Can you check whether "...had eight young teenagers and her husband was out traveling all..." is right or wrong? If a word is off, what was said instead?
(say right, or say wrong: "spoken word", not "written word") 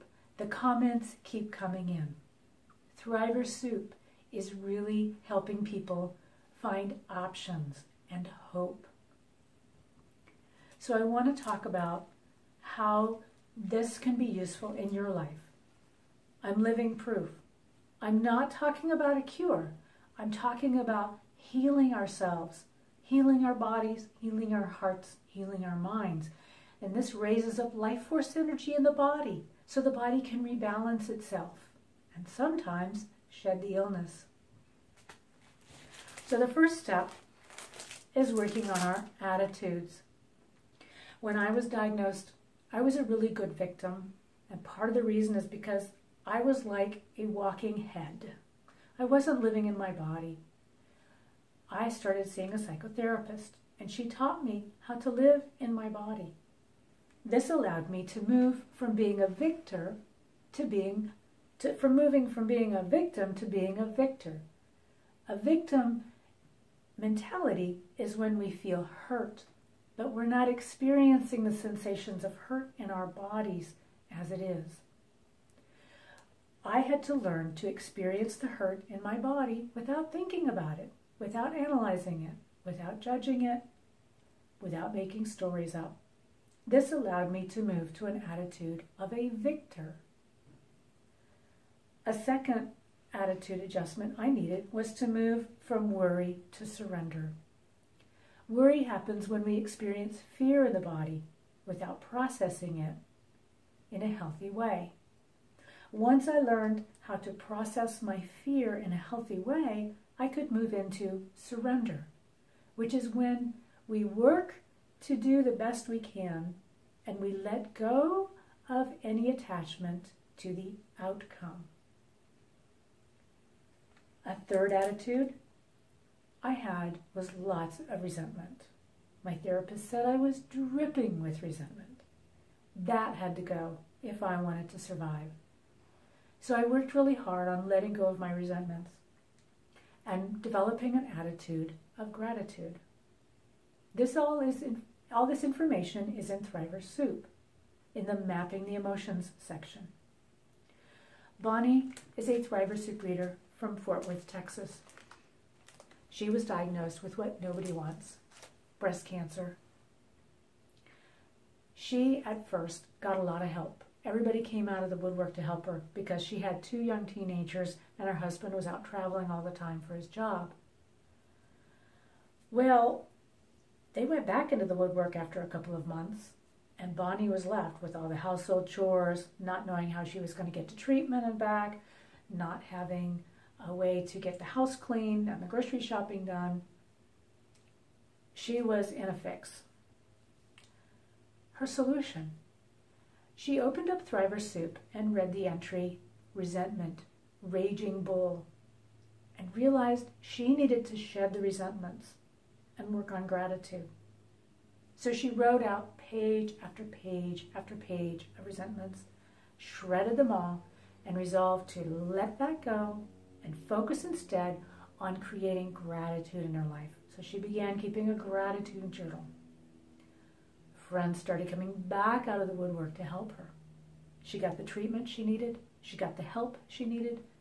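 wrong: "two", not "eight".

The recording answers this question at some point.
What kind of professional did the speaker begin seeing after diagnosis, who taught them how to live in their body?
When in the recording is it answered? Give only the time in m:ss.
0:52.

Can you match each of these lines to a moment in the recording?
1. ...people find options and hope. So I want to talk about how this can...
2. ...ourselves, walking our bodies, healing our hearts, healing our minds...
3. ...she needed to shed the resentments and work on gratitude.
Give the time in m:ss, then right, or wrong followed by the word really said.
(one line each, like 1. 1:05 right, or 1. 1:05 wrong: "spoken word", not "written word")
1. 0:05 right
2. 0:21 wrong: "healing", not "walking"
3. 3:20 right.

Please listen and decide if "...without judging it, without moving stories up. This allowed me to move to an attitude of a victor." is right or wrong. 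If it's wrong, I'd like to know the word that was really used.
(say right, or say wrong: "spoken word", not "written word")
wrong: "making", not "moving".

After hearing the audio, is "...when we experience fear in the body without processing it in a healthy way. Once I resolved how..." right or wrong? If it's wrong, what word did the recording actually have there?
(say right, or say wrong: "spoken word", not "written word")
wrong: "learned", not "resolved".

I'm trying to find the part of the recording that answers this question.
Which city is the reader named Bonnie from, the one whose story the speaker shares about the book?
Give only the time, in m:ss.
2:33.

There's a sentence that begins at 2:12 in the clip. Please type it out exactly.
That had to go if I wanted to survive.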